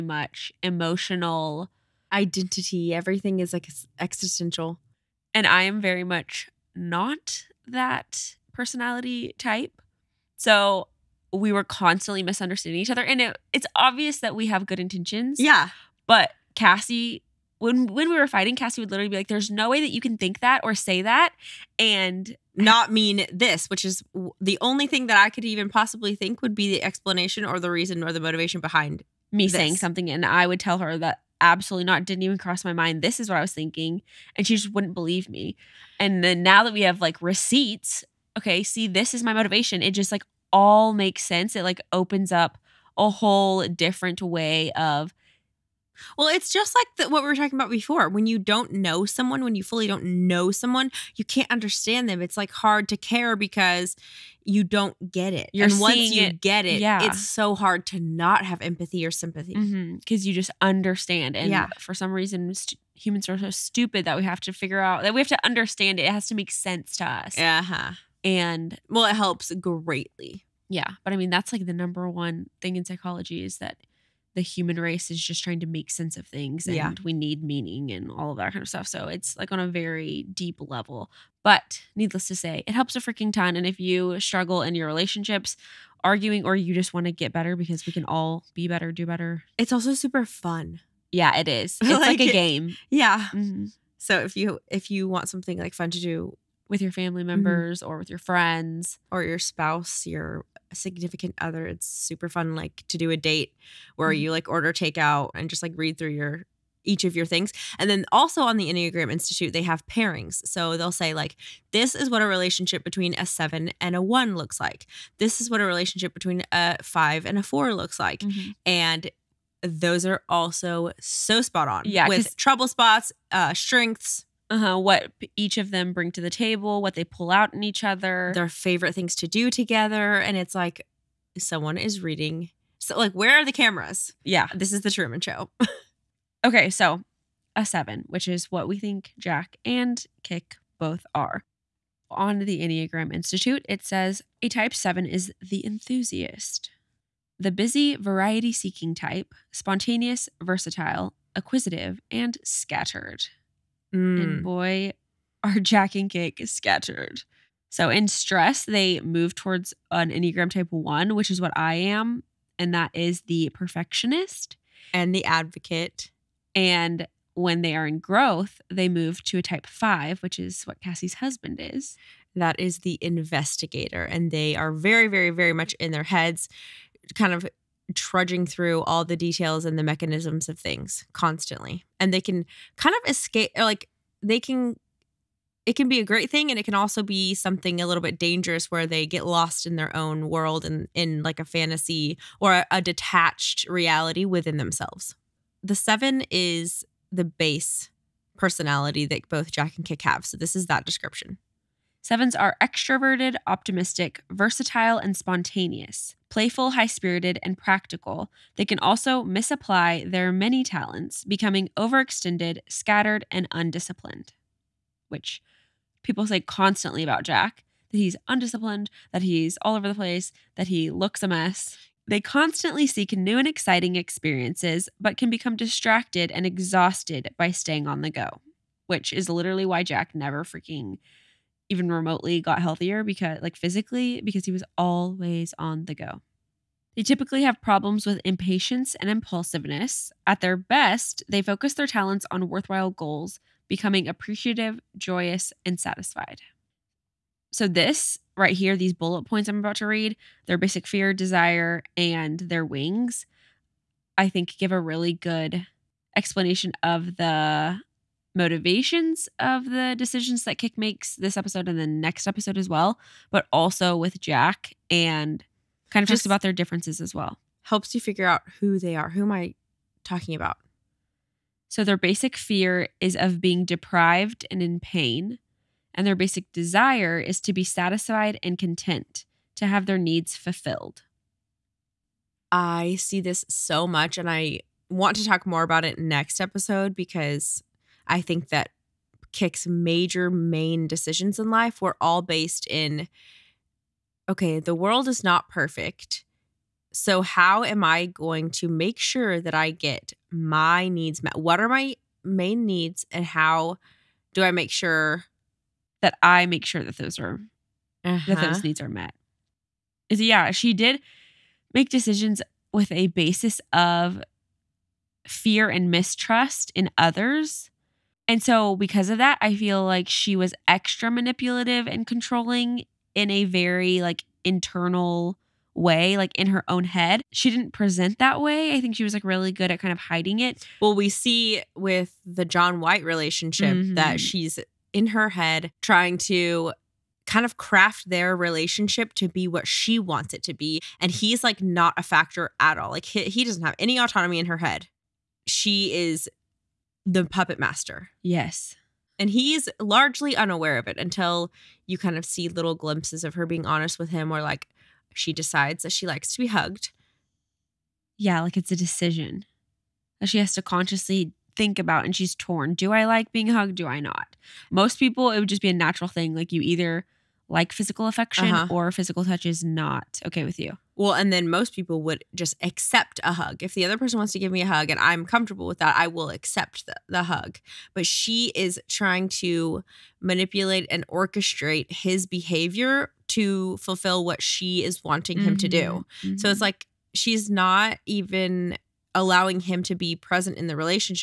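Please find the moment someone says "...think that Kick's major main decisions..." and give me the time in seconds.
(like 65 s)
288 s.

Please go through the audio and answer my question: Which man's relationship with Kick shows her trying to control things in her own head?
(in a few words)
John White.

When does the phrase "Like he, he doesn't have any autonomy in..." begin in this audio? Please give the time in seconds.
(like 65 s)
342 s.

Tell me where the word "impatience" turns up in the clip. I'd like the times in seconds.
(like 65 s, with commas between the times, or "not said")
238 s.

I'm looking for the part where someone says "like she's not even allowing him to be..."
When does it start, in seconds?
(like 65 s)
386 s.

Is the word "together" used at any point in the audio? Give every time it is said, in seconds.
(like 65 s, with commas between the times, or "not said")
129 s.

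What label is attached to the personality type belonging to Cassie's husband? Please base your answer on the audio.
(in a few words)
The investigator.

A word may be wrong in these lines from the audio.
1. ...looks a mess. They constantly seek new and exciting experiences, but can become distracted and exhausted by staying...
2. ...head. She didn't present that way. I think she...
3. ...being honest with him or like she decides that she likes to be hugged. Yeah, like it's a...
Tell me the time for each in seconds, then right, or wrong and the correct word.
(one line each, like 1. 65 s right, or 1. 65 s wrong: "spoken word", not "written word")
1. 220 s right
2. 326 s right
3. 353 s right.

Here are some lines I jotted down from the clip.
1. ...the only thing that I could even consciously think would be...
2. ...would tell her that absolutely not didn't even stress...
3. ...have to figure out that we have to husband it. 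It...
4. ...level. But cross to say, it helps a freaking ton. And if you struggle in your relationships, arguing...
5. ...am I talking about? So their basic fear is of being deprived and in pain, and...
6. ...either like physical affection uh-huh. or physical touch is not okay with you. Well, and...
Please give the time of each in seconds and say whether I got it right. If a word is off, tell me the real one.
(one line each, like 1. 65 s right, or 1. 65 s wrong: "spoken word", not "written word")
1. 24 s wrong: "possibly", not "consciously"
2. 30 s wrong: "cross", not "stress"
3. 64 s wrong: "understand", not "husband"
4. 80 s wrong: "needless", not "cross"
5. 269 s right
6. 366 s right.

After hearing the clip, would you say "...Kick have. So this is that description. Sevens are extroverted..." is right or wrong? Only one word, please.
right.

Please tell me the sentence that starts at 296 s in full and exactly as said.
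So, how am I going to make sure that I get my needs met?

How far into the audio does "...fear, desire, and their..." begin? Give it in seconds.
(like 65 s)
250 s.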